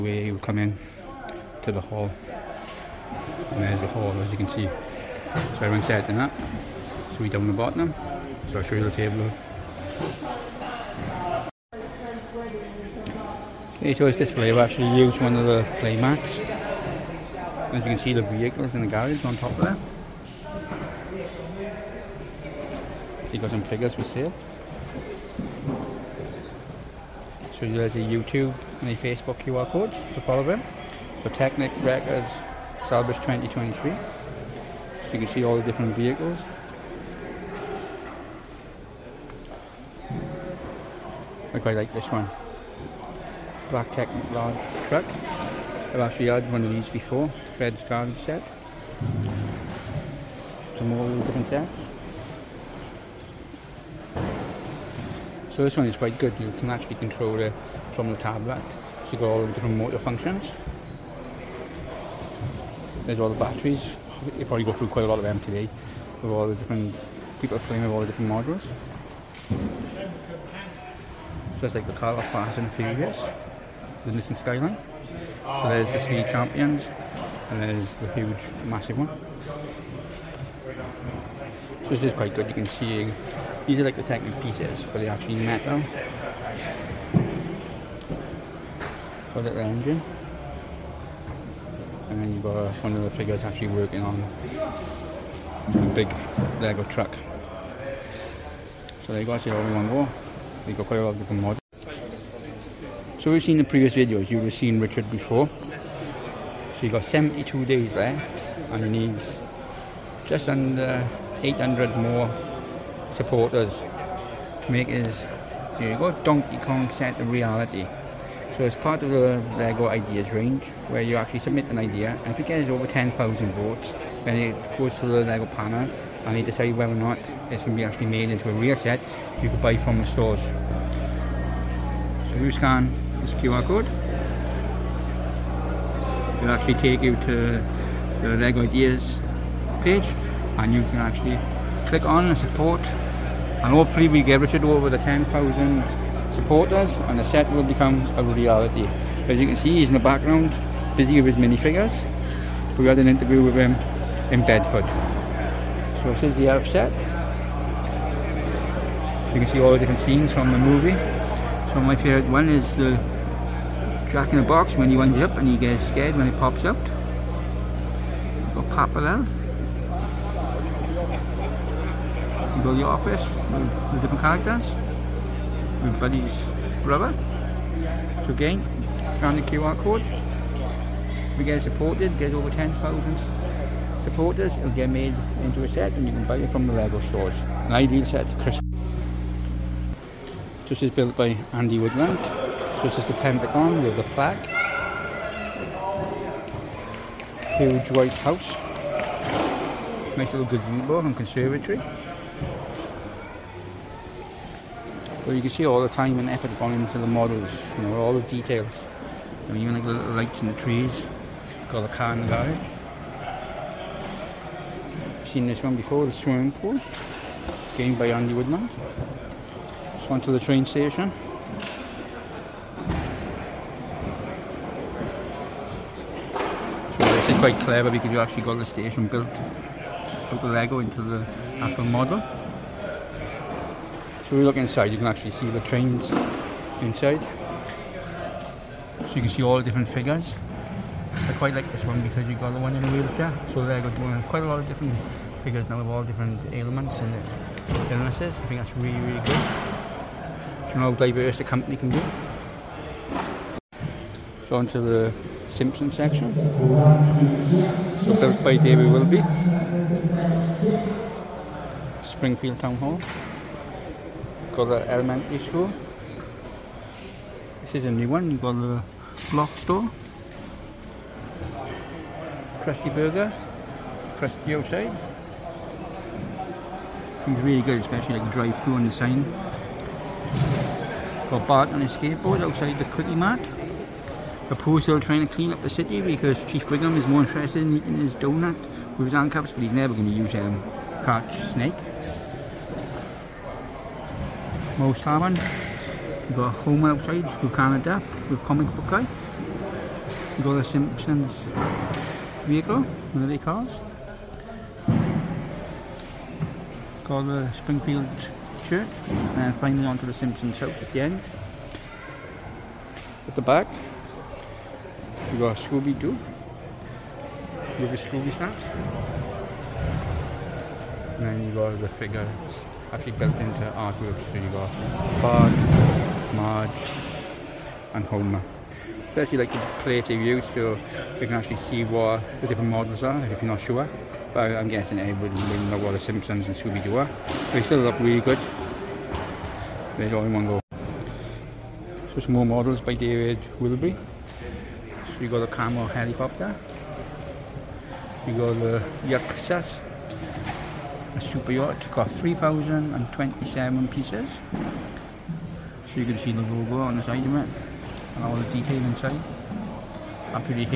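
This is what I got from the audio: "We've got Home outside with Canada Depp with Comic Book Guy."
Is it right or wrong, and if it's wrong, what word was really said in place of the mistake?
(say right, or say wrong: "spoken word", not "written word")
right.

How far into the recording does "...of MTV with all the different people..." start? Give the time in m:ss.
1:05.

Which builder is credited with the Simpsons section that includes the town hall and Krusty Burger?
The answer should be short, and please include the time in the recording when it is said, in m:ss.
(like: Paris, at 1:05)
David Wilby, at 4:18.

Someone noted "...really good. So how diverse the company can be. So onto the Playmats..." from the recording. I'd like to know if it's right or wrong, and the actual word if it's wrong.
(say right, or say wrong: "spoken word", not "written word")
wrong: "Simpson", not "Playmats".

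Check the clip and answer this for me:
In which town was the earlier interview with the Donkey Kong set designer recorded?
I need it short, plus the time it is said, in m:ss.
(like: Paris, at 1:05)
Bedford, at 2:34.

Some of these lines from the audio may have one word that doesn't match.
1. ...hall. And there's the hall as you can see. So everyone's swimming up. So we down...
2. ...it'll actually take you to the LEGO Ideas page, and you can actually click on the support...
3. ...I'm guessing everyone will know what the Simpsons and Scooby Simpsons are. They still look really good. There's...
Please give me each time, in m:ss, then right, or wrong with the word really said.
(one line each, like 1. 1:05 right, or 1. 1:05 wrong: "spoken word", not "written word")
1. 0:01 wrong: "setting", not "swimming"
2. 2:16 right
3. 5:34 wrong: "Doo", not "Simpsons".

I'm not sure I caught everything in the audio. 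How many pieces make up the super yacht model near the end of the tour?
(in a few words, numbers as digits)
3,027.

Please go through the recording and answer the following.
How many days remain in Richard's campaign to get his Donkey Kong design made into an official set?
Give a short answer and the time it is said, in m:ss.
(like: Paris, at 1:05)
72, at 1:47.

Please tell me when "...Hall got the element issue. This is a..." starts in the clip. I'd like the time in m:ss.
4:22.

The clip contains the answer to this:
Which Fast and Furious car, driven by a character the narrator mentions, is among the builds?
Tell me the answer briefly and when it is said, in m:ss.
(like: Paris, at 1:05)
Nissan Skyline, at 1:14.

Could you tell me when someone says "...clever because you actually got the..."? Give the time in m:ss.
3:47.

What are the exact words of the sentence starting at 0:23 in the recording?
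You got some figures for sale.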